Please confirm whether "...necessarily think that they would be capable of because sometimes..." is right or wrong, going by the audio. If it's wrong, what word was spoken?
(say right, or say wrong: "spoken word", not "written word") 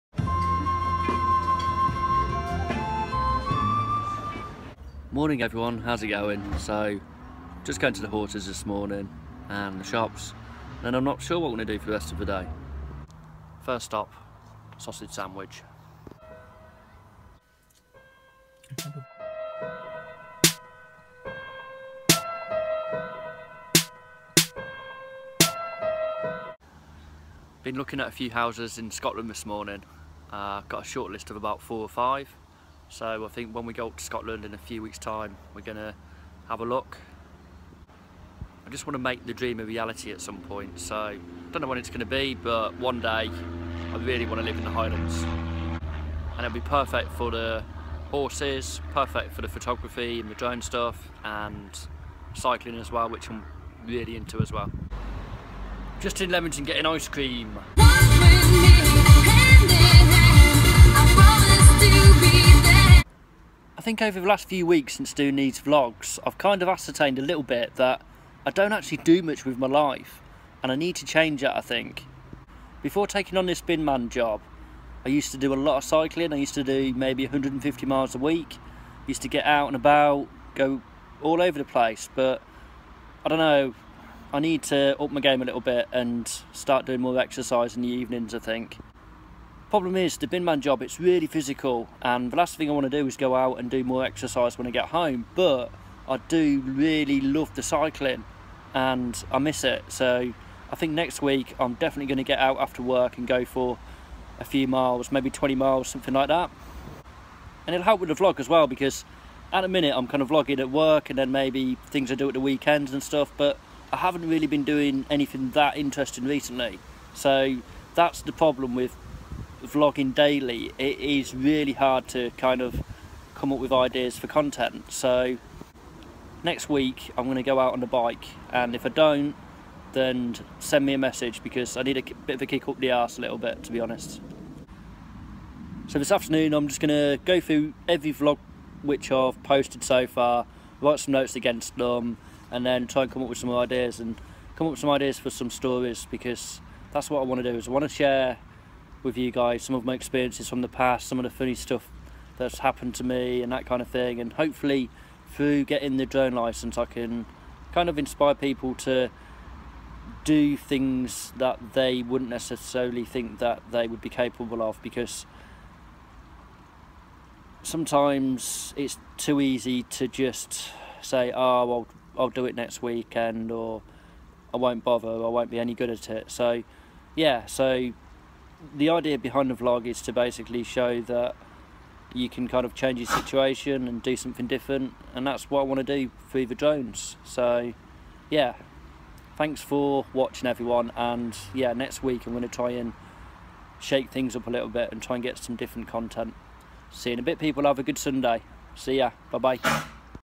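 right.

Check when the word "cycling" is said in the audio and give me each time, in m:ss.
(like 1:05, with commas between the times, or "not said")
0:52, 1:15, 1:37.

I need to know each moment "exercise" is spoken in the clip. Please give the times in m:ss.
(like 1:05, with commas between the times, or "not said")
1:27, 1:34.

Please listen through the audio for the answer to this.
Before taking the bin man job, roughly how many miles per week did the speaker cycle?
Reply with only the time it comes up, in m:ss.
1:17.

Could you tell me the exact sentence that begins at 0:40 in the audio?
So I don't know when it's gonna be, but one day I really wanna live in the Highlands.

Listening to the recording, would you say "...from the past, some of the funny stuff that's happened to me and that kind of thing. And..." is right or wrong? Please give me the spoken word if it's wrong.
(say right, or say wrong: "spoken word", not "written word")
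right.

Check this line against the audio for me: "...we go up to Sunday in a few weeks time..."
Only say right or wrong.
wrong.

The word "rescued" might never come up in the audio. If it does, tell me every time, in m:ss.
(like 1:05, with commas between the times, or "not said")
not said.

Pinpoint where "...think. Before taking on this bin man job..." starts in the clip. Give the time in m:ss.
1:11.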